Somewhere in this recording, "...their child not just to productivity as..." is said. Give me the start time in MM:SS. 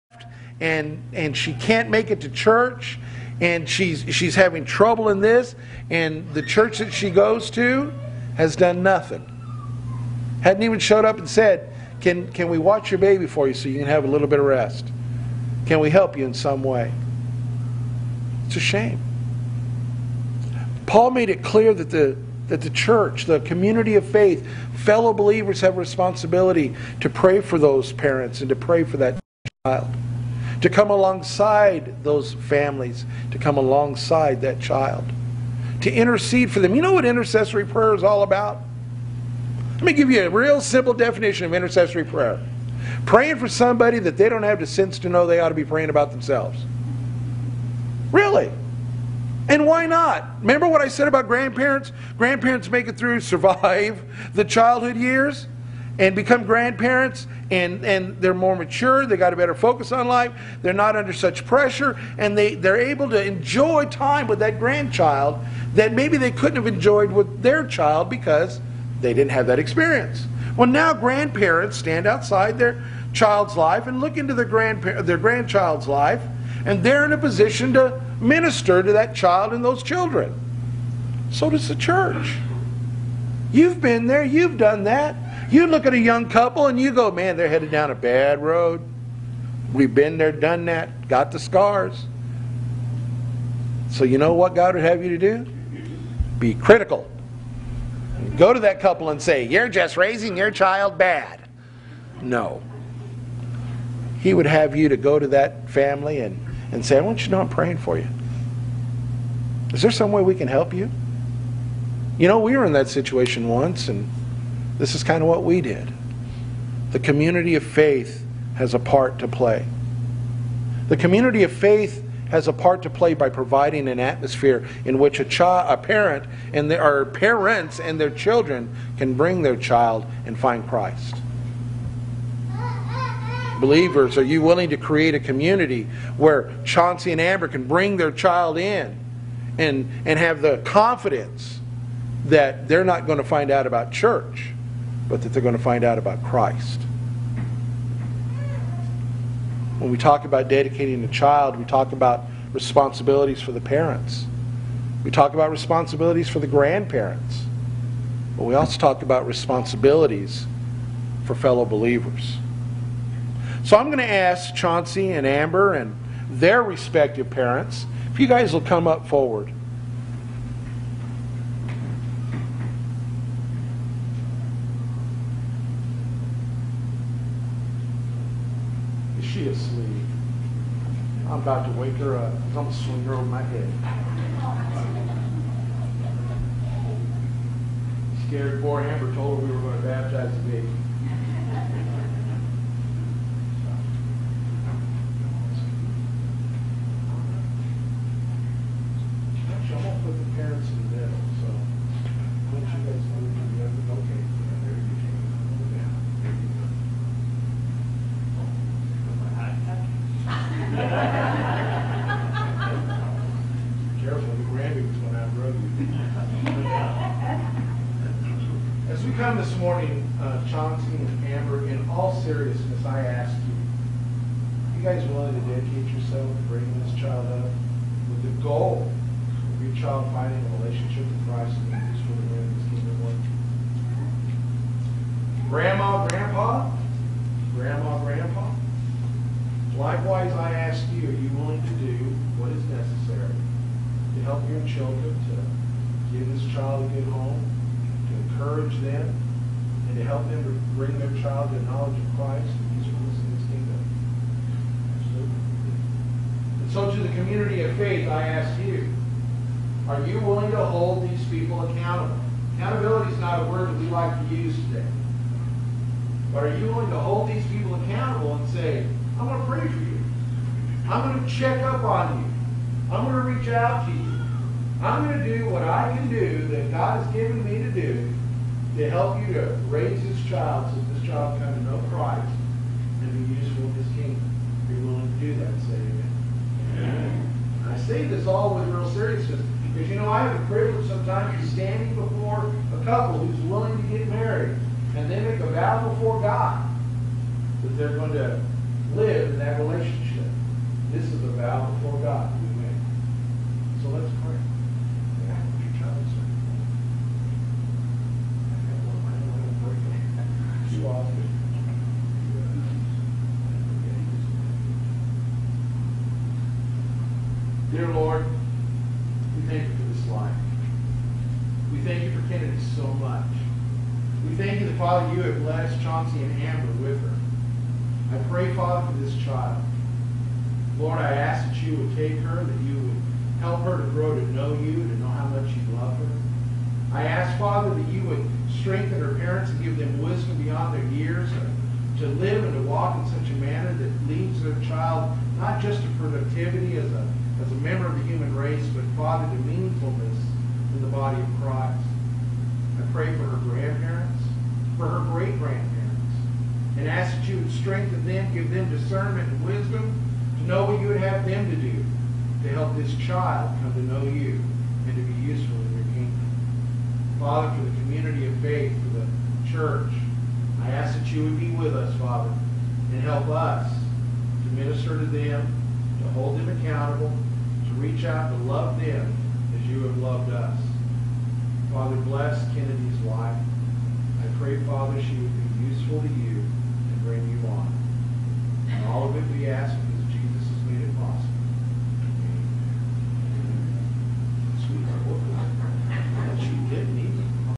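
05:44.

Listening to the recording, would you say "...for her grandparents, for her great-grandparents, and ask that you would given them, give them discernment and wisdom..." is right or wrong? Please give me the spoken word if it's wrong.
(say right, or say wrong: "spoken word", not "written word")
wrong: "strengthen", not "given".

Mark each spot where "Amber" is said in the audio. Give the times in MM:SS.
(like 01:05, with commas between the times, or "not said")
02:17, 02:45, 03:08, 03:41, 05:26.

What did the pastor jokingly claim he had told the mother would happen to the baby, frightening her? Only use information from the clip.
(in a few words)
Baptize the baby.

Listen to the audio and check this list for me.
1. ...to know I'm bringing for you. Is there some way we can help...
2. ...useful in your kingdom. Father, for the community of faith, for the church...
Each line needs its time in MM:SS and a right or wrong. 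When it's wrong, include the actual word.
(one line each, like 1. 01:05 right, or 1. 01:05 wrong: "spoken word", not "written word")
1. 01:47 wrong: "praying", not "bringing"
2. 06:05 right.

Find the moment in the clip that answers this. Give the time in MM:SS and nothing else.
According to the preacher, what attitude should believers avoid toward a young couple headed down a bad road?
01:36.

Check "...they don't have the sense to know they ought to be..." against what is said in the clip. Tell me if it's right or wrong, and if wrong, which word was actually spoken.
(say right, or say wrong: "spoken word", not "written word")
right.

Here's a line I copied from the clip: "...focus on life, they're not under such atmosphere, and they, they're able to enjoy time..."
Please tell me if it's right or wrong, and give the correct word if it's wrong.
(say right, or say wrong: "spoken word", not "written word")
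wrong: "pressure", not "atmosphere".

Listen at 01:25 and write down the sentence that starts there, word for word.
You look at a young couple and you go, man, they're headed down a bad road.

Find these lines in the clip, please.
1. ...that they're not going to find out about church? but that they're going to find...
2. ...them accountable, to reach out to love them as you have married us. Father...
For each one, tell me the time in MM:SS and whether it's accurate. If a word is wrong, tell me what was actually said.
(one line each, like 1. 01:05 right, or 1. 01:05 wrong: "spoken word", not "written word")
1. 02:22 right
2. 06:16 wrong: "loved", not "married".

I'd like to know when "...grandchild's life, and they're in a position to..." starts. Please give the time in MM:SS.
01:15.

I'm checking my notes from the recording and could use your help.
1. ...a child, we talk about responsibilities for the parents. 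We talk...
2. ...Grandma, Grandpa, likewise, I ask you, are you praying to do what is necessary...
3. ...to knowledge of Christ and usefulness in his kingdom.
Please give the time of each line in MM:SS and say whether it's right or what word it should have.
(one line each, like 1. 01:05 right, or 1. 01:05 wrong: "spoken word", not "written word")
1. 02:31 right
2. 03:57 wrong: "willing", not "praying"
3. 04:11 right.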